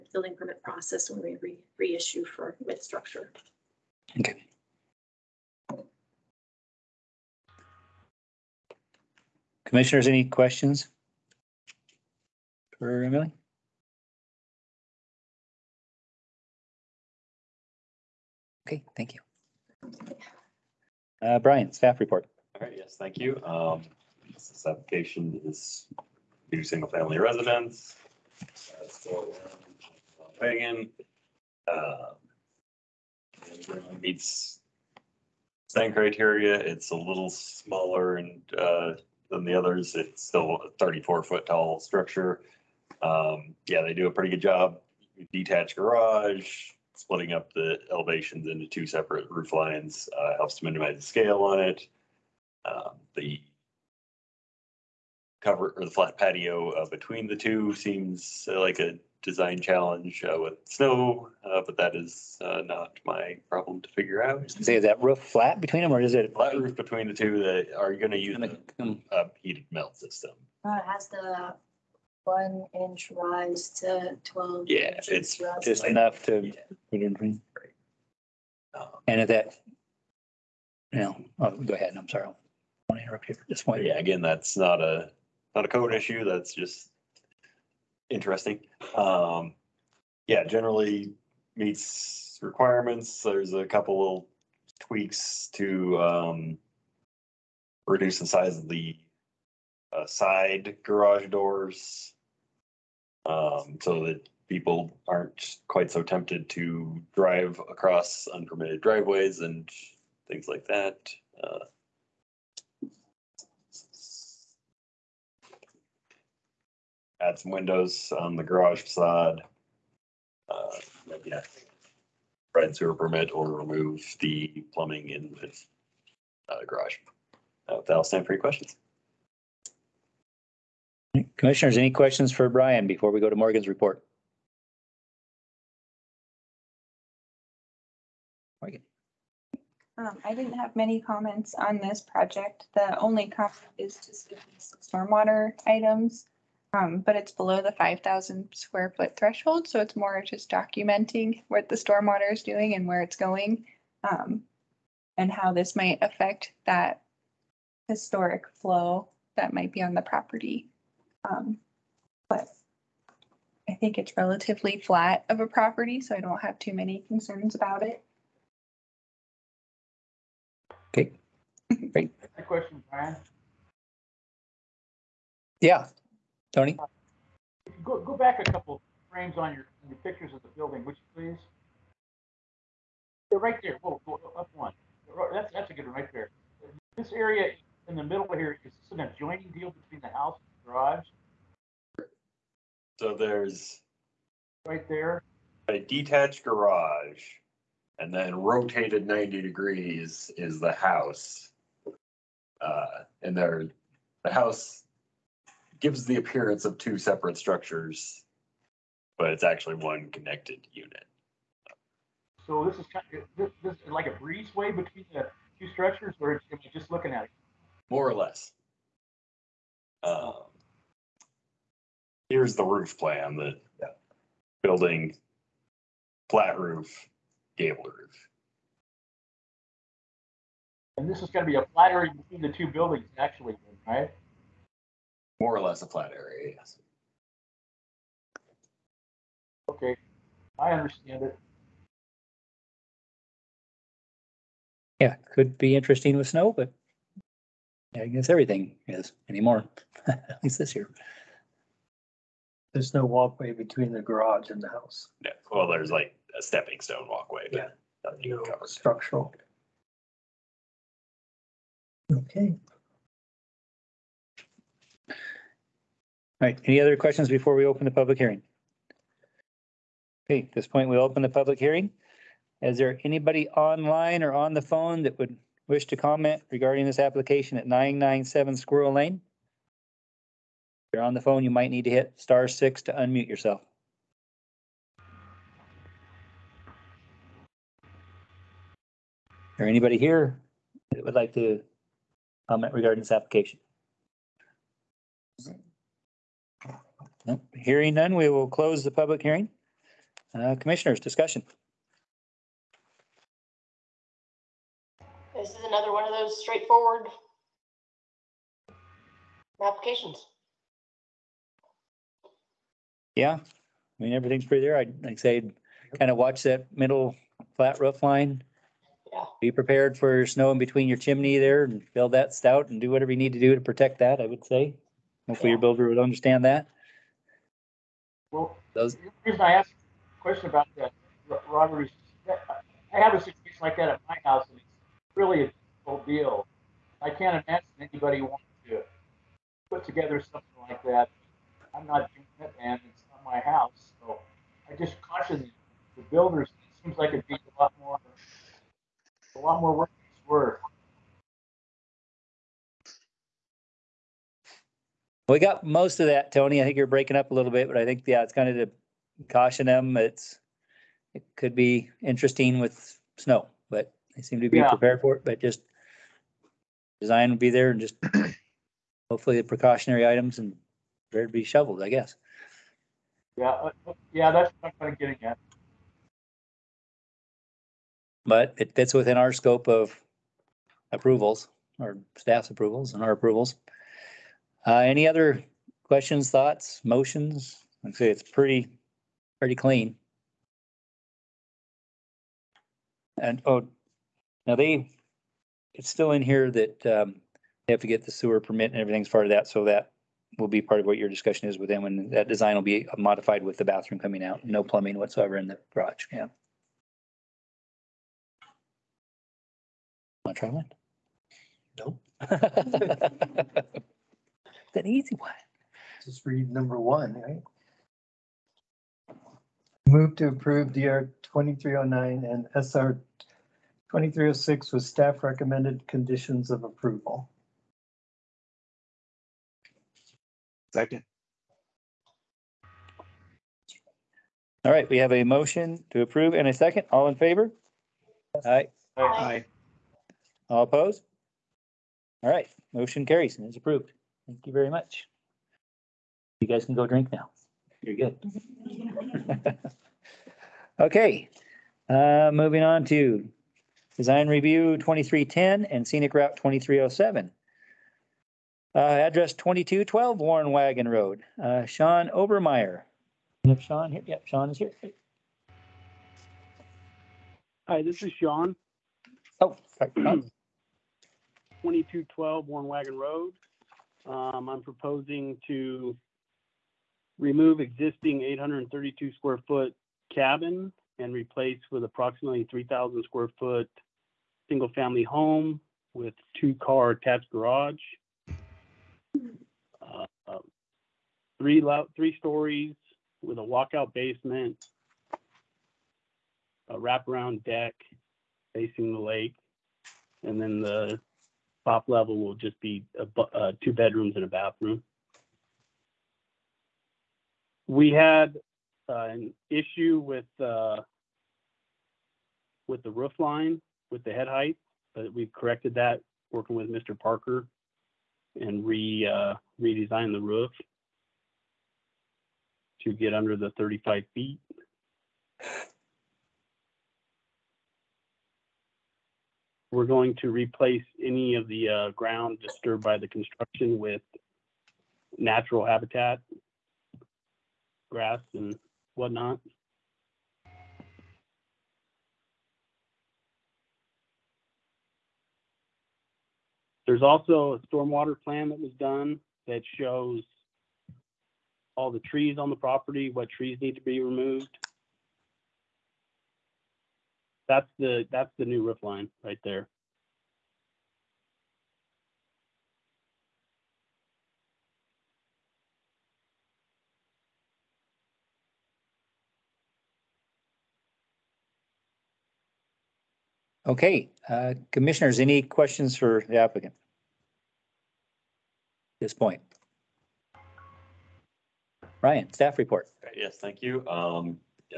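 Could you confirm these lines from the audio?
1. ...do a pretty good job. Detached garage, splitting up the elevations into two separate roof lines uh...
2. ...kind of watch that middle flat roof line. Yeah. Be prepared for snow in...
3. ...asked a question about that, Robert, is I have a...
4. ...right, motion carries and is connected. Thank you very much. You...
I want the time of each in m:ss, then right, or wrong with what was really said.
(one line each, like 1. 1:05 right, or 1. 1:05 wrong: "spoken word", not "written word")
1. 0:43 right
2. 5:15 right
3. 5:29 right
4. 7:22 wrong: "approved", not "connected".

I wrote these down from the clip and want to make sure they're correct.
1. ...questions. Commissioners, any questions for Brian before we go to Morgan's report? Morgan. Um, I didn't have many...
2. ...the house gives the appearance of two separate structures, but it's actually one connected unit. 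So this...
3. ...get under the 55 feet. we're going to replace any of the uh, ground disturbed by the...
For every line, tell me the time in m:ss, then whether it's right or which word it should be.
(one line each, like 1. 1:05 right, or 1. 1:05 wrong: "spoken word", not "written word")
1. 2:08 right
2. 3:24 right
3. 8:42 wrong: "35", not "55".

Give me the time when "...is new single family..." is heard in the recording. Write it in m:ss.
0:25.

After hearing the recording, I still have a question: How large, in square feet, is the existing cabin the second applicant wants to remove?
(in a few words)
832 square feet.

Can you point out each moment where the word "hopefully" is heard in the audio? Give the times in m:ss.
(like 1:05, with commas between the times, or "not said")
5:25, 6:09.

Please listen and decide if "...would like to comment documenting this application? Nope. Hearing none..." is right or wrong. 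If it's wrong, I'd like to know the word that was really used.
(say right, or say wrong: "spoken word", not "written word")
wrong: "regarding", not "documenting".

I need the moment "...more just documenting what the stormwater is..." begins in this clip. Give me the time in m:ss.
2:29.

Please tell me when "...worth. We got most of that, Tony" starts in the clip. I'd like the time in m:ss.
5:50.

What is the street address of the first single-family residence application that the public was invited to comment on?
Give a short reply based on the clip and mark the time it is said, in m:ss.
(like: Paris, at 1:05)
997 Squirrel Lane, at 4:37.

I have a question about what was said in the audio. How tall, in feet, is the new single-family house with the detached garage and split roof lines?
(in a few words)
34 feet.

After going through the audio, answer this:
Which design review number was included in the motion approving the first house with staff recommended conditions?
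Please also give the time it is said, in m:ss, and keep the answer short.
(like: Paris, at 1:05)
DR 2309, at 7:00.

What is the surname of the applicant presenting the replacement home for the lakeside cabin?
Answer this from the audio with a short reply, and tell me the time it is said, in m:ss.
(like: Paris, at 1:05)
Obermeyer, at 7:42.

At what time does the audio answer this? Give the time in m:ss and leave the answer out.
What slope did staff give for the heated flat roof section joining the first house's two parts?
1:12.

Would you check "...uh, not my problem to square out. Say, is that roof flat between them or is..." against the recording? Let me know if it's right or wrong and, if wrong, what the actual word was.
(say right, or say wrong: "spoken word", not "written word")
wrong: "figure", not "square".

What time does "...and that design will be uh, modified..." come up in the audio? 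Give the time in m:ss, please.
6:41.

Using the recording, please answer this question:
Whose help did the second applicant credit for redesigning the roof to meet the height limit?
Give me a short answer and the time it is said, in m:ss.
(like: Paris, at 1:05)
Mr. Parker, at 8:36.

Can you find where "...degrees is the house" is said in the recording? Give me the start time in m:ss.
3:19.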